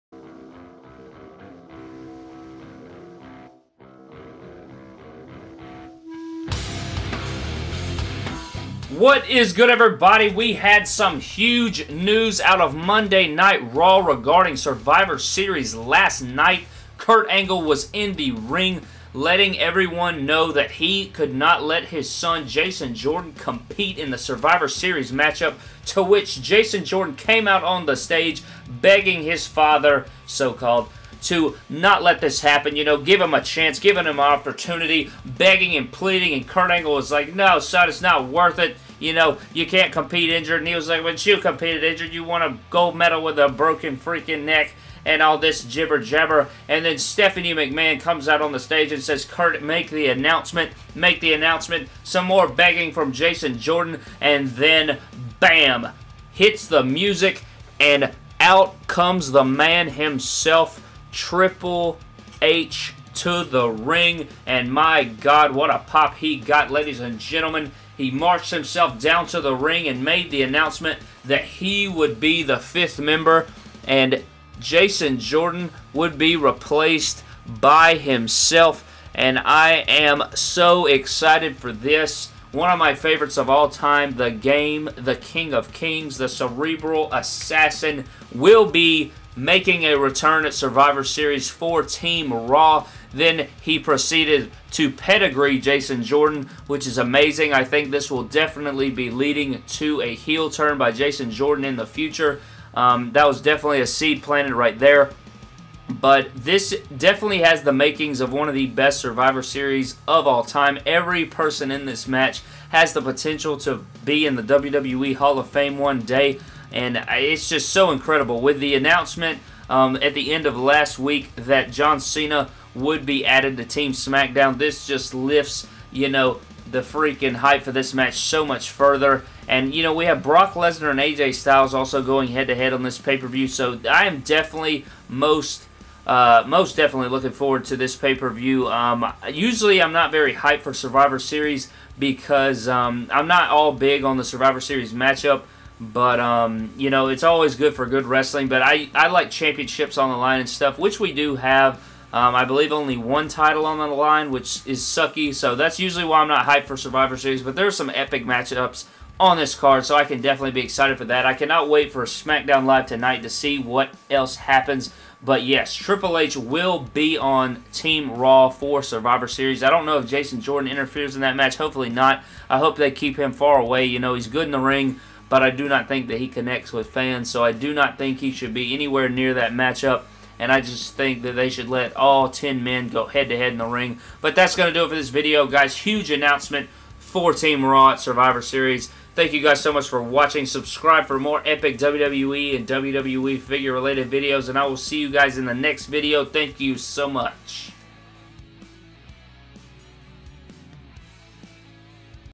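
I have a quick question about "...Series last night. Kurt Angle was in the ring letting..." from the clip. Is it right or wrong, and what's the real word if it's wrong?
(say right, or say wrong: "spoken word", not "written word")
right.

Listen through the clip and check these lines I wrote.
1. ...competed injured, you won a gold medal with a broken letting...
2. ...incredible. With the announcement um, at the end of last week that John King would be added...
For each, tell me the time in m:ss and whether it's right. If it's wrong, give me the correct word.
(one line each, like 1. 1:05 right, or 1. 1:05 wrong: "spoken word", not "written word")
1. 0:41 wrong: "freaking", not "letting"
2. 1:57 wrong: "Cena", not "King".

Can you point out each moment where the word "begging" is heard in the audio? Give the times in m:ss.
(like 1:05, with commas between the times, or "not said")
0:28, 0:35, 0:52.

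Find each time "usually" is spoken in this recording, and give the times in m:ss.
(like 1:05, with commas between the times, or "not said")
2:19, 2:35.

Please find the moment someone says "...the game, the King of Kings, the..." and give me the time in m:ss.
1:24.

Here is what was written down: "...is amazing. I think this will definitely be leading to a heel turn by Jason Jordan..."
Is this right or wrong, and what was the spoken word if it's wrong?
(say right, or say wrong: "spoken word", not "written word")
right.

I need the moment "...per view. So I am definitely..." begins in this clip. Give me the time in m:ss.
2:13.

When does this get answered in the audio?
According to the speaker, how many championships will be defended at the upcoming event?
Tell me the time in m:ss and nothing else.
2:32.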